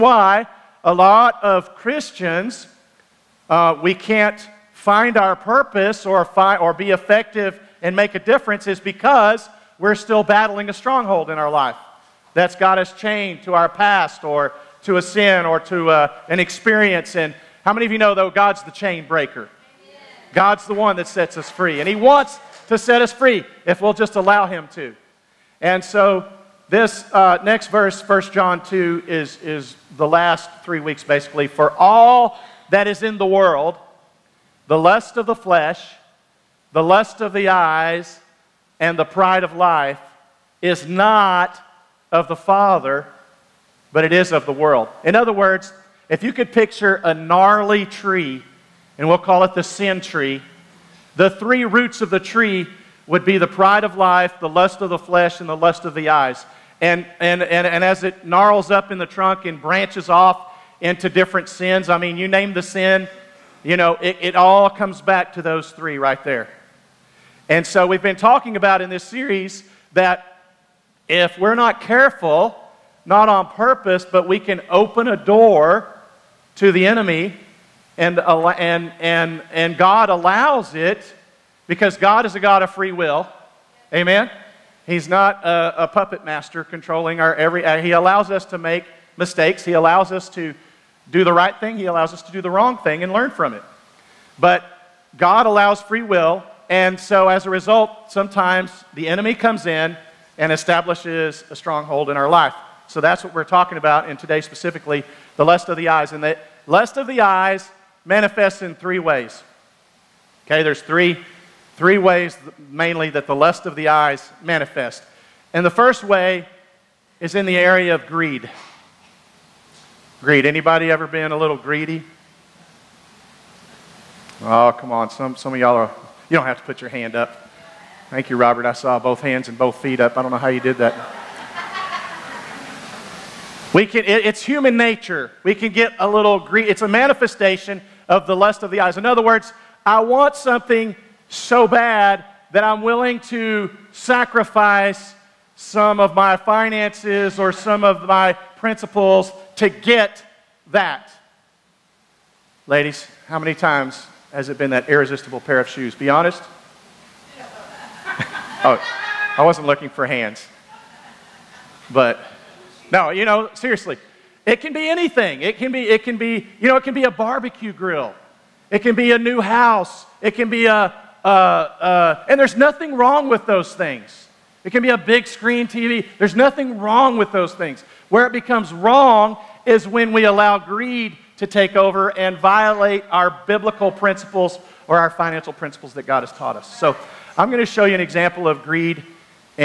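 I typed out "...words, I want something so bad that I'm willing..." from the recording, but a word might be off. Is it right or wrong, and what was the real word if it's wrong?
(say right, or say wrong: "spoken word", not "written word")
right.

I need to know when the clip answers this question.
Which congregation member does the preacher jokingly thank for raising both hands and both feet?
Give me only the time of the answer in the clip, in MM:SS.
02:08.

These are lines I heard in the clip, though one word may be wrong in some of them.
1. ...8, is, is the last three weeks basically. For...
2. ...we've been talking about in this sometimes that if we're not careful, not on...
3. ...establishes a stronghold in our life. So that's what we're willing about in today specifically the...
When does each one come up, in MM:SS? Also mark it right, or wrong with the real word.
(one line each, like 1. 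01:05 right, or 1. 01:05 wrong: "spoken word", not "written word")
1. 00:28 wrong: "2", not "8"
2. 01:07 wrong: "series", not "sometimes"
3. 01:40 wrong: "talking", not "willing".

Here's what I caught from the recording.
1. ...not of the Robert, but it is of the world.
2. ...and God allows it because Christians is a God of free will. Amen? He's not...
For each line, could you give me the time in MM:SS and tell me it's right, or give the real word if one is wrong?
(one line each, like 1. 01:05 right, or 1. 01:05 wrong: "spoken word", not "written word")
1. 00:40 wrong: "Father", not "Robert"
2. 01:19 wrong: "God", not "Christians".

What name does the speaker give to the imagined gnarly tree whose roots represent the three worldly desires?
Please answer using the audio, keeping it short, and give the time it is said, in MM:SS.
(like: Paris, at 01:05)
the sin tree, at 00:49.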